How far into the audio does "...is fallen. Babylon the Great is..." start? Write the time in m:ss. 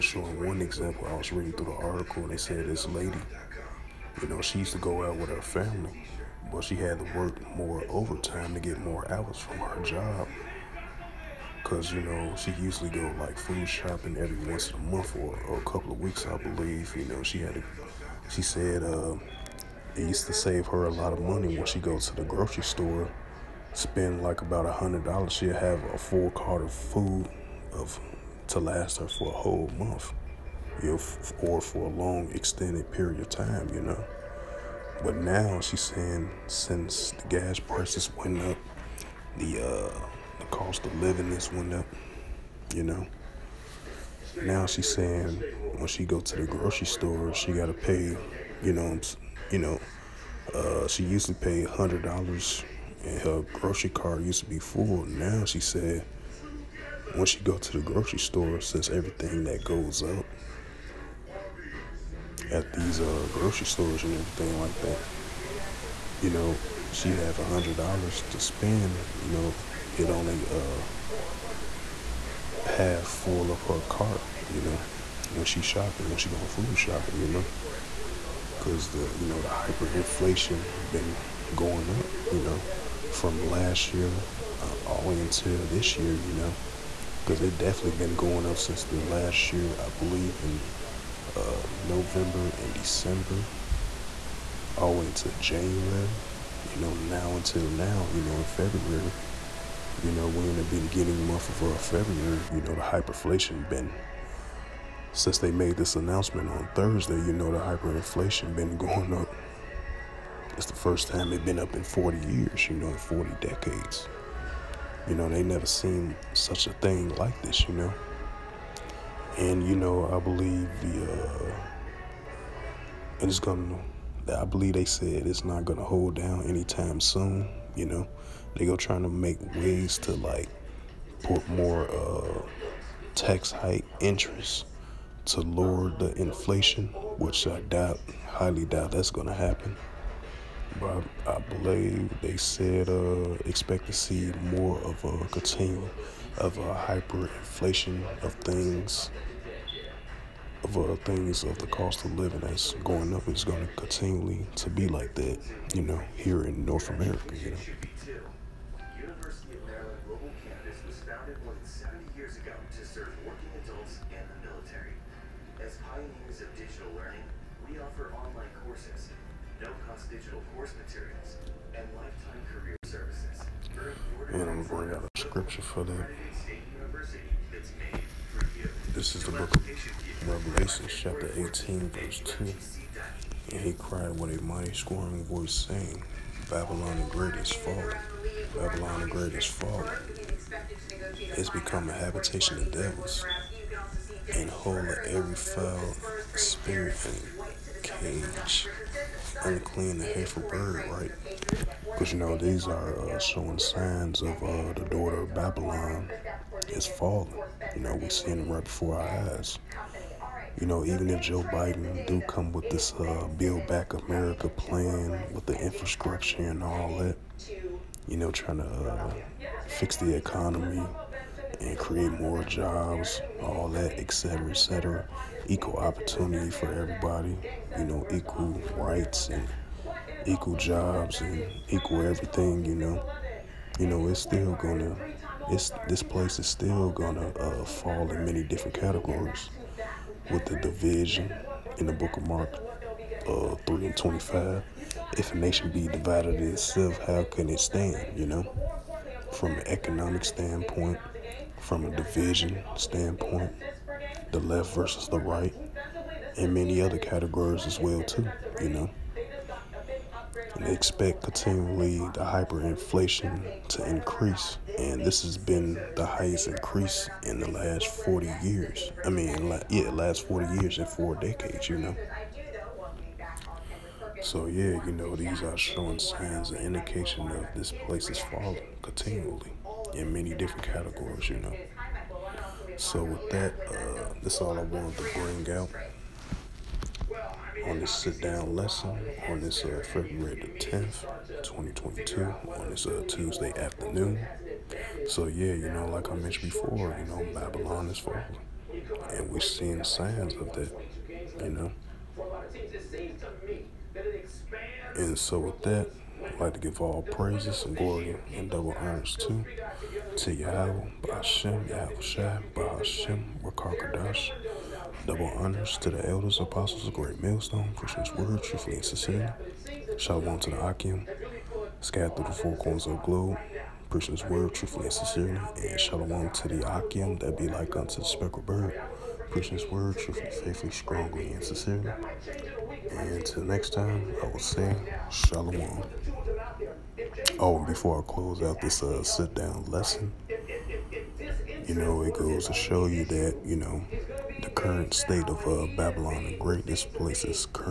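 3:07.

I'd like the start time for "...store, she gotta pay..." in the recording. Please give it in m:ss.
0:46.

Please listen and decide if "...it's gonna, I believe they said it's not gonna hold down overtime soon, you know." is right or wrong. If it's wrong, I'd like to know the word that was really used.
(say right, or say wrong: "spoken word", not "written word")
wrong: "anytime", not "overtime".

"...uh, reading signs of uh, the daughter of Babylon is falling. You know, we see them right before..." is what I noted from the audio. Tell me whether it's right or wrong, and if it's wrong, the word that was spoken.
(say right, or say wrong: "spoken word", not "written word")
wrong: "showing", not "reading".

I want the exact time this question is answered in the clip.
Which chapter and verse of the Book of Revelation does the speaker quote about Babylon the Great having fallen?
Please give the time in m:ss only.
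3:00.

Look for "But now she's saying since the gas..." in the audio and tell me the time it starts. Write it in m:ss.
0:35.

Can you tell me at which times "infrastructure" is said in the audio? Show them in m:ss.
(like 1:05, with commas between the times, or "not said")
3:35.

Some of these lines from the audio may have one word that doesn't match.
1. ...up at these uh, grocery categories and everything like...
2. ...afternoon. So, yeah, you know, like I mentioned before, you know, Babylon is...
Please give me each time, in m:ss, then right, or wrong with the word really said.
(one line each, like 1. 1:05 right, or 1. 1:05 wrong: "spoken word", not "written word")
1. 1:00 wrong: "stores", not "categories"
2. 4:53 right.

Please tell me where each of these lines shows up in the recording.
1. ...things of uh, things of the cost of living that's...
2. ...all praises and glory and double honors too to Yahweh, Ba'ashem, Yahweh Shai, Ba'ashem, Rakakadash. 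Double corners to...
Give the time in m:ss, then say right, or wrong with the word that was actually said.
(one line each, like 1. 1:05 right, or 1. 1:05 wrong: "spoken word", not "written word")
1. 2:28 right
2. 5:06 wrong: "honors", not "corners".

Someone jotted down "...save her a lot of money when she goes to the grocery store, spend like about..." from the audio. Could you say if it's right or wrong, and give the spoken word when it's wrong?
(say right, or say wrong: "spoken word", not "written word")
right.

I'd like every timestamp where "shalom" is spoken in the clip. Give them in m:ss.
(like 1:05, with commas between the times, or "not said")
5:19, 5:25, 5:35.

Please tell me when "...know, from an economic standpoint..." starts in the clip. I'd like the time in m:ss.
4:08.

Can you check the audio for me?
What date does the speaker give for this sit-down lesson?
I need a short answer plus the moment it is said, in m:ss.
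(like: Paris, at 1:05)
February 10, 2022, at 4:49.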